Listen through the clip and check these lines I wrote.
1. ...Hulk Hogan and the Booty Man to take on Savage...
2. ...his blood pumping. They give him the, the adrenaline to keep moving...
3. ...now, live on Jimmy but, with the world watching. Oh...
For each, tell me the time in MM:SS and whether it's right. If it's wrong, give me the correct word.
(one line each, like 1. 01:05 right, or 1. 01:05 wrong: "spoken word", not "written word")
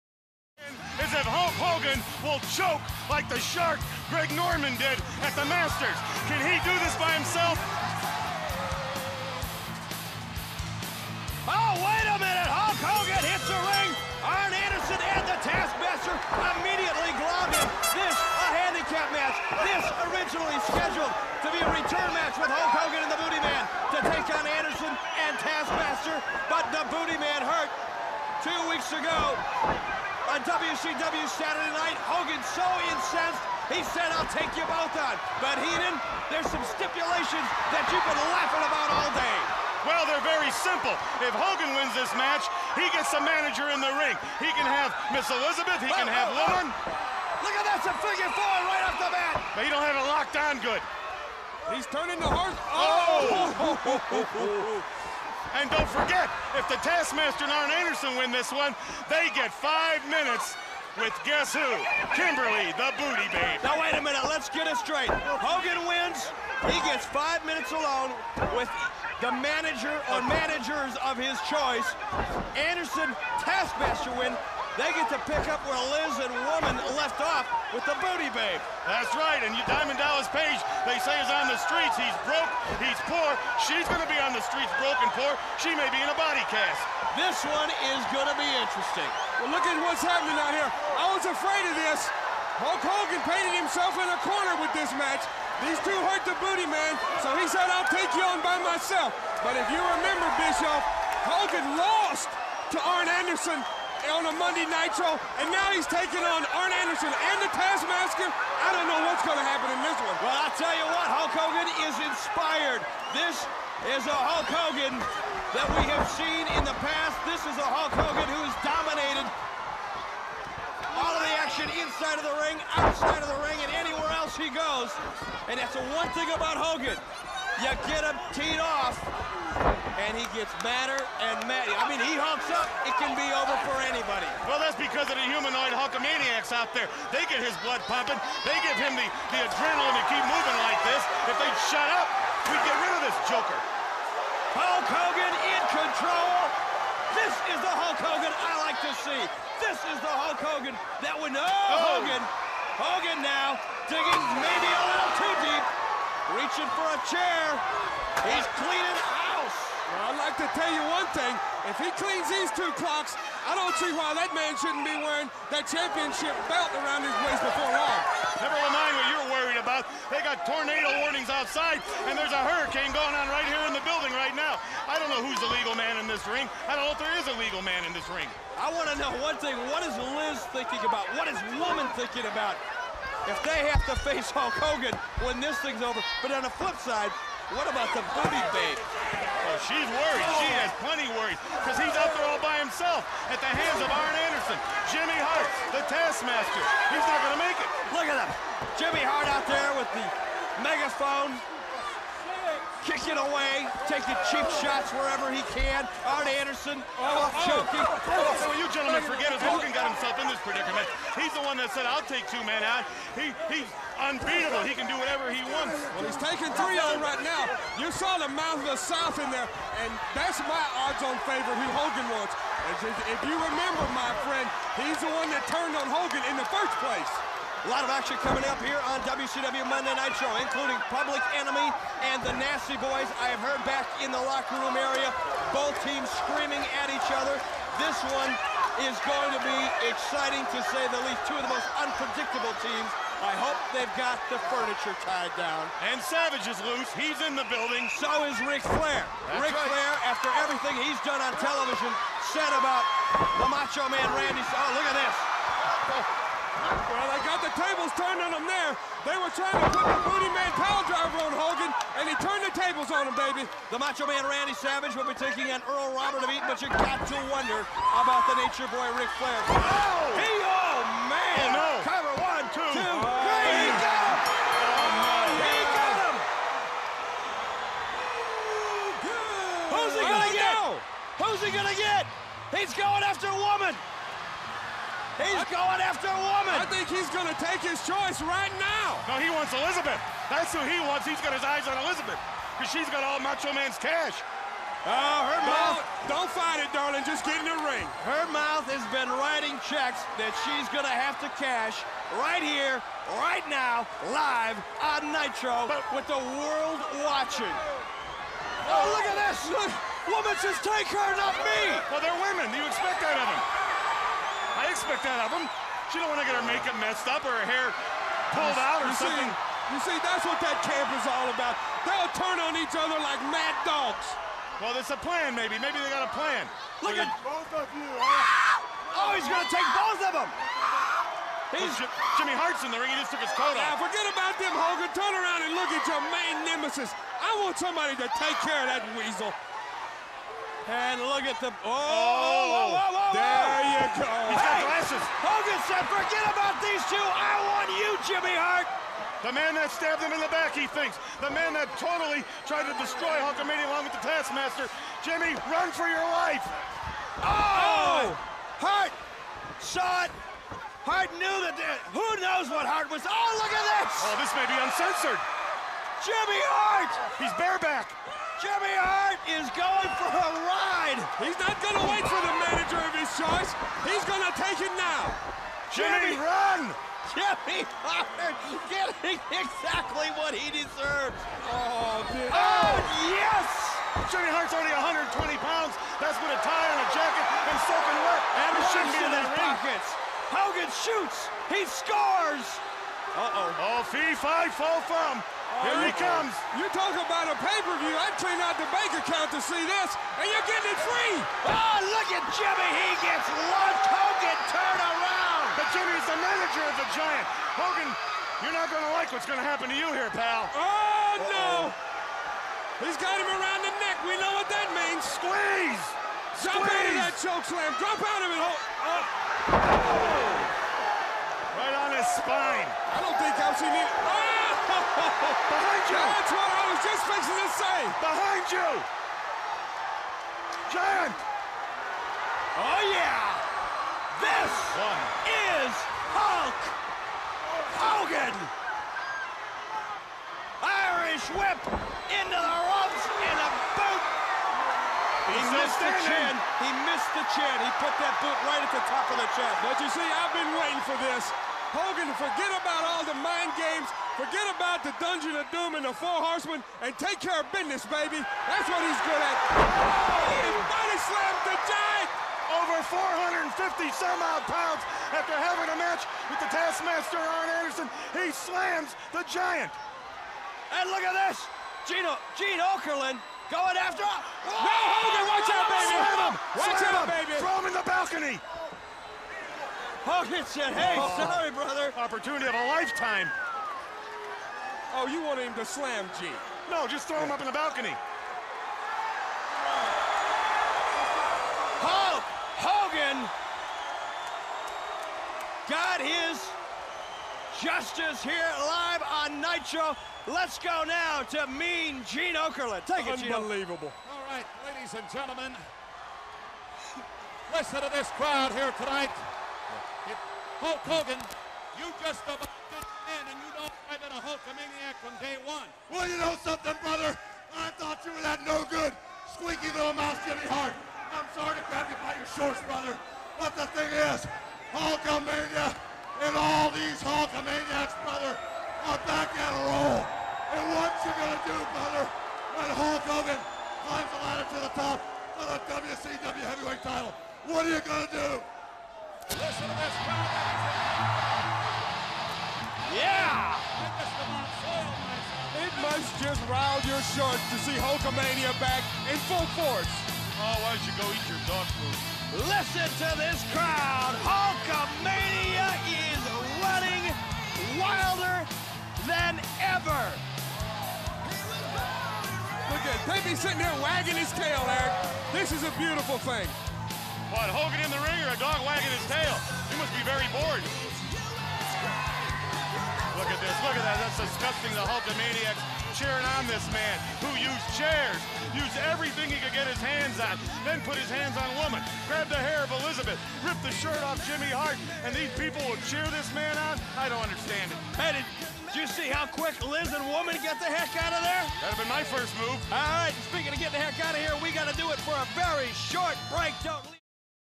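1. 00:22 wrong: "Anderson", not "Savage"
2. 02:17 right
3. 05:03 wrong: "Nitro", not "Jimmy".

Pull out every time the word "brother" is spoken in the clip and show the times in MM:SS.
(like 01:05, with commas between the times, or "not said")
08:01, 08:36, 08:42.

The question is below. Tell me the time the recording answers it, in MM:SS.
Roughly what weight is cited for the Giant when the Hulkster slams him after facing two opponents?
07:43.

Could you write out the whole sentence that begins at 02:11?
I mean, he humps up, it can be over for anybody.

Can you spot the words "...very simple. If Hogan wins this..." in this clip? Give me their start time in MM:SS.
00:40.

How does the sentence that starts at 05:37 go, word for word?
I want somebody to take care of that weasel.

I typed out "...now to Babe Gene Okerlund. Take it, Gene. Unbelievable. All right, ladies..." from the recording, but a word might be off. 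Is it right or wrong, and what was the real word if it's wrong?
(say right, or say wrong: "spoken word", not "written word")
wrong: "Mean", not "Babe".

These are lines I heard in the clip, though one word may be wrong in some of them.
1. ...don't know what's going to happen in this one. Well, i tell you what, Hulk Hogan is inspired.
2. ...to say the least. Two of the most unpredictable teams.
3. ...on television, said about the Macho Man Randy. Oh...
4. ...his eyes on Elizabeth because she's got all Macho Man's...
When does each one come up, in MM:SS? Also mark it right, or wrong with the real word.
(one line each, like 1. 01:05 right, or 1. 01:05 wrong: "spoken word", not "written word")
1. 01:48 right
2. 04:00 right
3. 04:11 right
4. 04:51 right.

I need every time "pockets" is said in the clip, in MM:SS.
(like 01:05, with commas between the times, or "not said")
06:29.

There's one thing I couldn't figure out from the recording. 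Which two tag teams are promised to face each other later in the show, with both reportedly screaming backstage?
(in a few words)
Public Enemy and the Nasty Boys.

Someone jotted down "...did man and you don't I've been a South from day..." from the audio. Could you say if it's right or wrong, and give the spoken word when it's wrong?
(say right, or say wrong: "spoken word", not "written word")
wrong: "Hulkamaniac", not "South".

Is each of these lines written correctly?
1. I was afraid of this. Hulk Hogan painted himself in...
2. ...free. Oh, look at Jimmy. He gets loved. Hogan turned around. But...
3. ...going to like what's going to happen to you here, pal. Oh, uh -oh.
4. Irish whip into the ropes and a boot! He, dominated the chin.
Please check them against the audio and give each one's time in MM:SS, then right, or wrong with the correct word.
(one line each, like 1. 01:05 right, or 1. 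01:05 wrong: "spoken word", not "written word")
1. 01:30 right
2. 06:40 right
3. 06:48 right
4. 07:20 wrong: "missed", not "dominated".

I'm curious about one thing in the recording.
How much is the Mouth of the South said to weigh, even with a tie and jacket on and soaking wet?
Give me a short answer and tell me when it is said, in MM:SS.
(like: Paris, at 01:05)
120 pounds, at 06:24.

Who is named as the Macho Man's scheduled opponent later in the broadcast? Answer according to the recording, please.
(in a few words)
Earl Robert of Eaton.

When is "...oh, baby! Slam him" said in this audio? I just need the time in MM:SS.
07:55.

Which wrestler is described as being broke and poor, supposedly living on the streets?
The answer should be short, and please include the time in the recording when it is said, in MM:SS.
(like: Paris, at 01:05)
Diamond Dallas Page, at 01:19.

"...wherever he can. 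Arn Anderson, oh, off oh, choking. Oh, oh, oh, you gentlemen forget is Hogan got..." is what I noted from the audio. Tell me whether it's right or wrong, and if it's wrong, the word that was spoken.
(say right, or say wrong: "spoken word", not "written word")
right.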